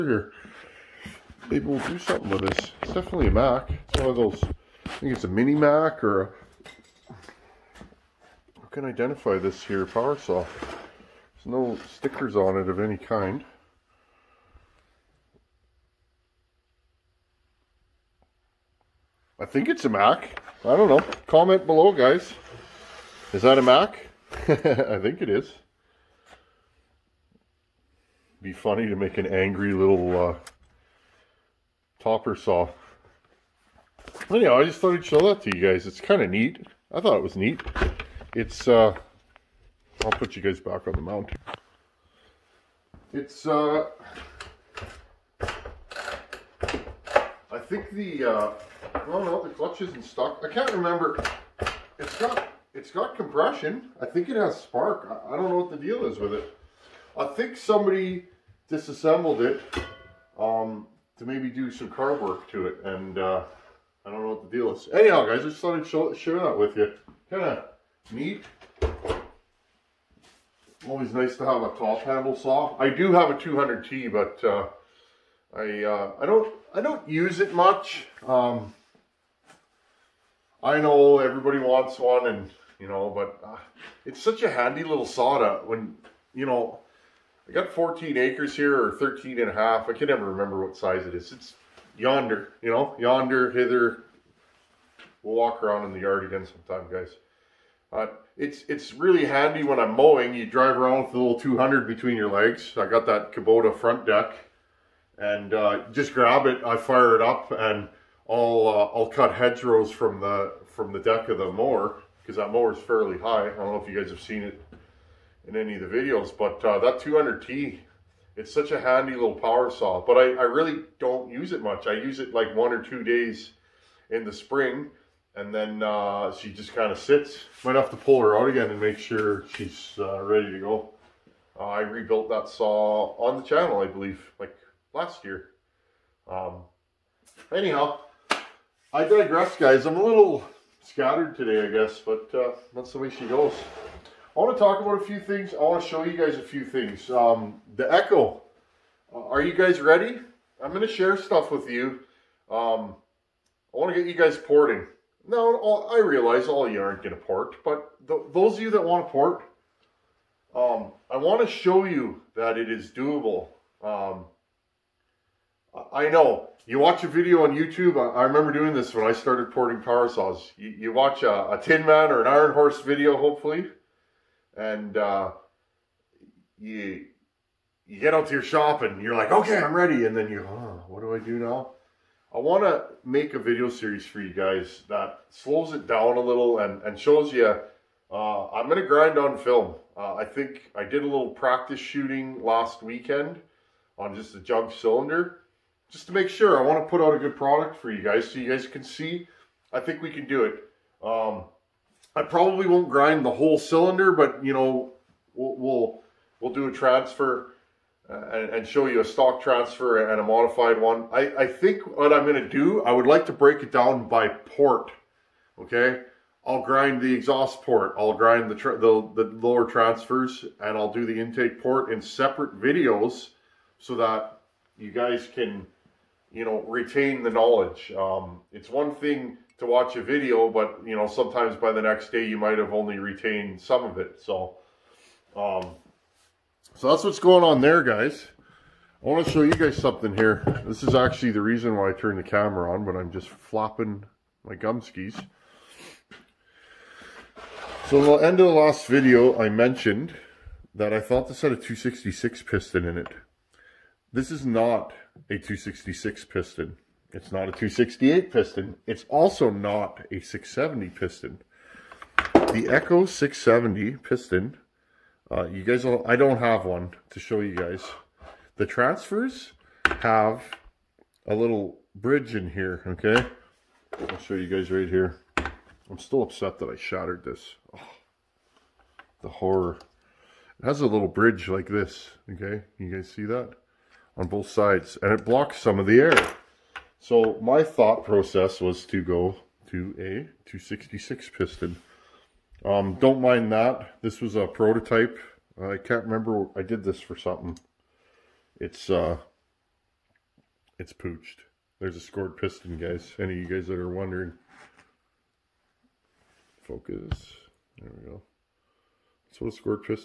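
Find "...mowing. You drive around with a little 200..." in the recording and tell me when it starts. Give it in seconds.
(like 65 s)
99 s.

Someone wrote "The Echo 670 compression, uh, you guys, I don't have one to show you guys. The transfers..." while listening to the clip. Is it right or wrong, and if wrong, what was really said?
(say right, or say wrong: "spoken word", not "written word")
wrong: "piston", not "compression".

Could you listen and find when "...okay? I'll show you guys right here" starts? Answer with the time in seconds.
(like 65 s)
272 s.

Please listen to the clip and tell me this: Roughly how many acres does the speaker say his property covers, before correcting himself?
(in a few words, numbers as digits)
14.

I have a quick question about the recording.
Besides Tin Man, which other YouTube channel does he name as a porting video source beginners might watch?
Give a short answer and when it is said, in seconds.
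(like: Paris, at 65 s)
Iron Horse, at 172 s.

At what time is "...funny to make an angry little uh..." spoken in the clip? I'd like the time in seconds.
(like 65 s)
28 s.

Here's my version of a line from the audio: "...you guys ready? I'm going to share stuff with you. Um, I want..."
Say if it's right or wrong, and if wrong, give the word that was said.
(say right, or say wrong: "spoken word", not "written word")
right.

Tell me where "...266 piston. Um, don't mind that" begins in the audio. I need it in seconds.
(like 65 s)
290 s.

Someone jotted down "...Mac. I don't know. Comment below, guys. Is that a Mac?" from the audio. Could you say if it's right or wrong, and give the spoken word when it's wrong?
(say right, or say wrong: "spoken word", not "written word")
right.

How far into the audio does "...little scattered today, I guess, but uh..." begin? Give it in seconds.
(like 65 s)
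140 s.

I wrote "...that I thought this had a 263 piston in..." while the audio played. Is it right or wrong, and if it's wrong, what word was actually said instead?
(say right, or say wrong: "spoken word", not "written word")
wrong: "266", not "263".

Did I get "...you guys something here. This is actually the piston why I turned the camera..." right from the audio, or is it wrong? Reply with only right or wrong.
wrong.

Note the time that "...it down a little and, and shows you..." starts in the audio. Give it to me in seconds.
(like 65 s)
185 s.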